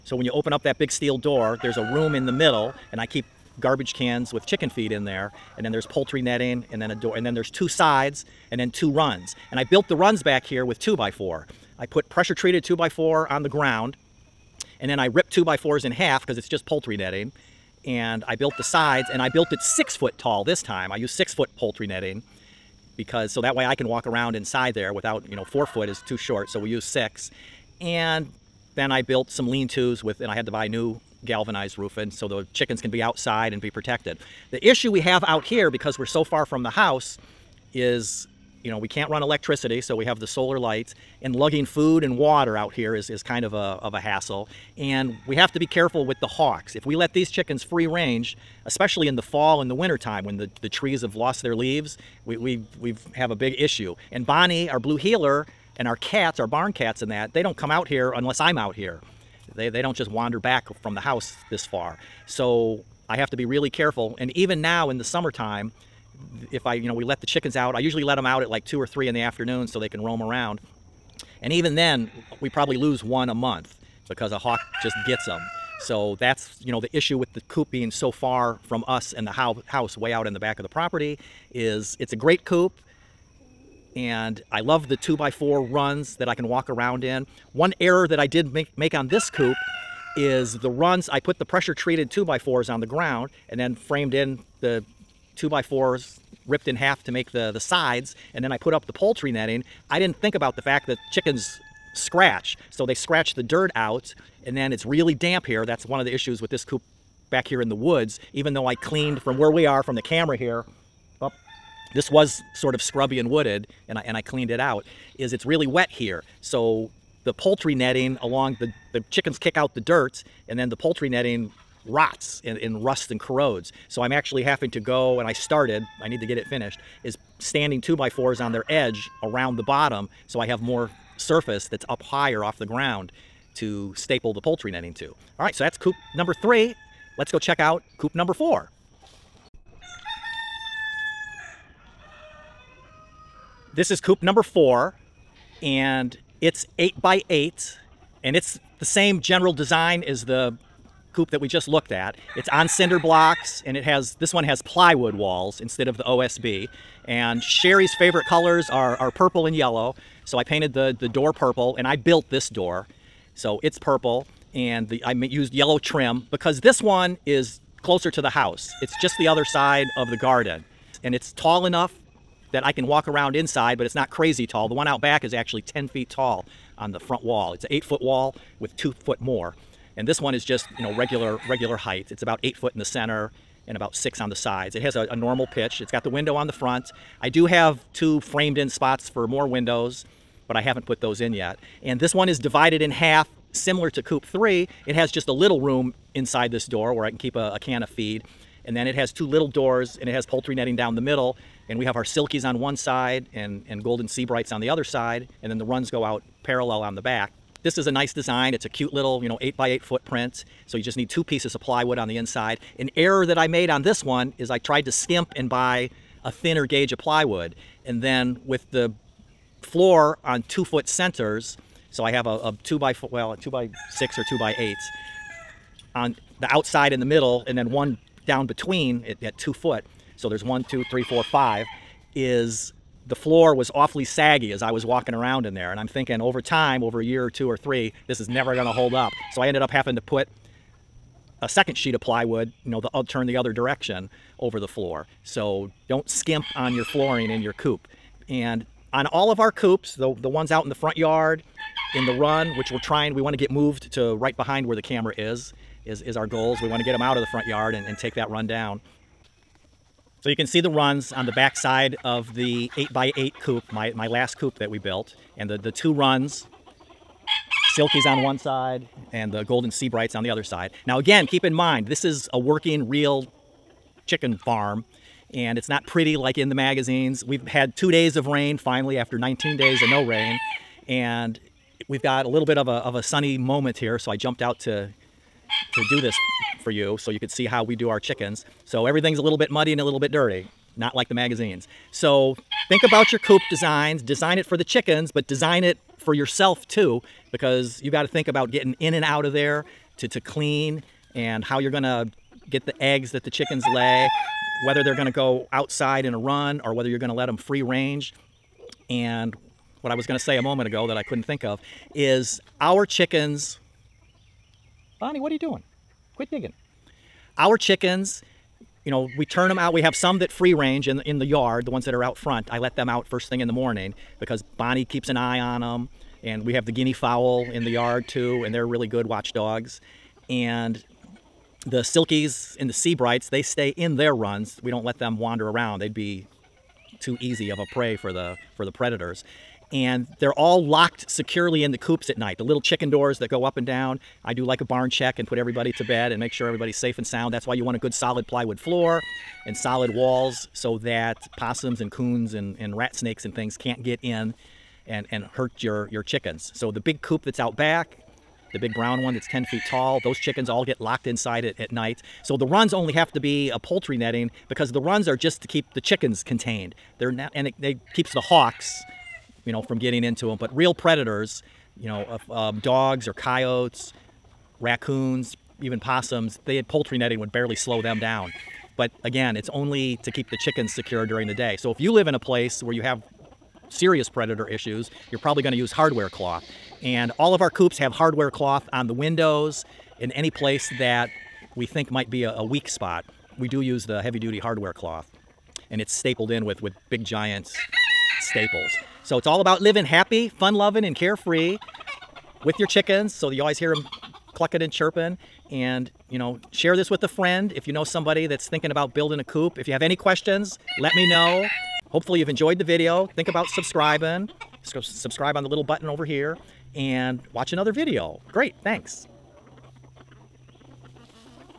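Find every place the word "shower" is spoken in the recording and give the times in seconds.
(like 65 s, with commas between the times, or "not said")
not said.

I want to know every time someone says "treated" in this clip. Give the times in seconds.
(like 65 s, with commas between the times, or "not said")
12 s, 91 s.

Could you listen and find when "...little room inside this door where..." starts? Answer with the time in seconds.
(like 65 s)
195 s.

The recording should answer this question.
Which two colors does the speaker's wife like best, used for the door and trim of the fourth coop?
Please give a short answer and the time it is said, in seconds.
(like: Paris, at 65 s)
purple and yellow, at 159 s.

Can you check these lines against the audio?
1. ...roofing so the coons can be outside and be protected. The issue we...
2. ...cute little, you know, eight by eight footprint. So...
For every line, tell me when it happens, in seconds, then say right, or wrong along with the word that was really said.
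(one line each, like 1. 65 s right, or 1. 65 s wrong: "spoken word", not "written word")
1. 31 s wrong: "chickens", not "coons"
2. 208 s right.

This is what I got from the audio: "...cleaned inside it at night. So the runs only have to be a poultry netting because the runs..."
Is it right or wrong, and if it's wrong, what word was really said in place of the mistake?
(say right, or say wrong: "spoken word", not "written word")
wrong: "locked", not "cleaned".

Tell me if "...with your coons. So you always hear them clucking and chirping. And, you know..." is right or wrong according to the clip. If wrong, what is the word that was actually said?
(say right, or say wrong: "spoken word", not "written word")
wrong: "chickens", not "coons".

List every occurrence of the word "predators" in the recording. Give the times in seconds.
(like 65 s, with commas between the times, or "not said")
338 s, 370 s, 384 s.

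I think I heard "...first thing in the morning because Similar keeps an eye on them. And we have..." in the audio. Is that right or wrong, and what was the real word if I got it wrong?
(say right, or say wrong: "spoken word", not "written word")
wrong: "Bonnie", not "Similar".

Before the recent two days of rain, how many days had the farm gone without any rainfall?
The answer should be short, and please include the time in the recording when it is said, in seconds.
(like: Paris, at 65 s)
19 days, at 279 s.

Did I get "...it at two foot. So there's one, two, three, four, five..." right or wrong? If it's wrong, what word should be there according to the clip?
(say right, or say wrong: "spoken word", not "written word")
right.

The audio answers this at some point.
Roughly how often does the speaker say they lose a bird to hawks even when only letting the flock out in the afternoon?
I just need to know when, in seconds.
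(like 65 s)
73 s.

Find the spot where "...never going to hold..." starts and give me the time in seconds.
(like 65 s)
238 s.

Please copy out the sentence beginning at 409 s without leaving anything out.
If you have any questions, let me know.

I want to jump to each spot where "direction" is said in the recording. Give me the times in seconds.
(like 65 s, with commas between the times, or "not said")
243 s.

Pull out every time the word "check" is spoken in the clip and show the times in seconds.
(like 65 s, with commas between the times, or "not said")
137 s, 344 s.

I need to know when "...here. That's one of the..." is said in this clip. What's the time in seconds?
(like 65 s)
105 s.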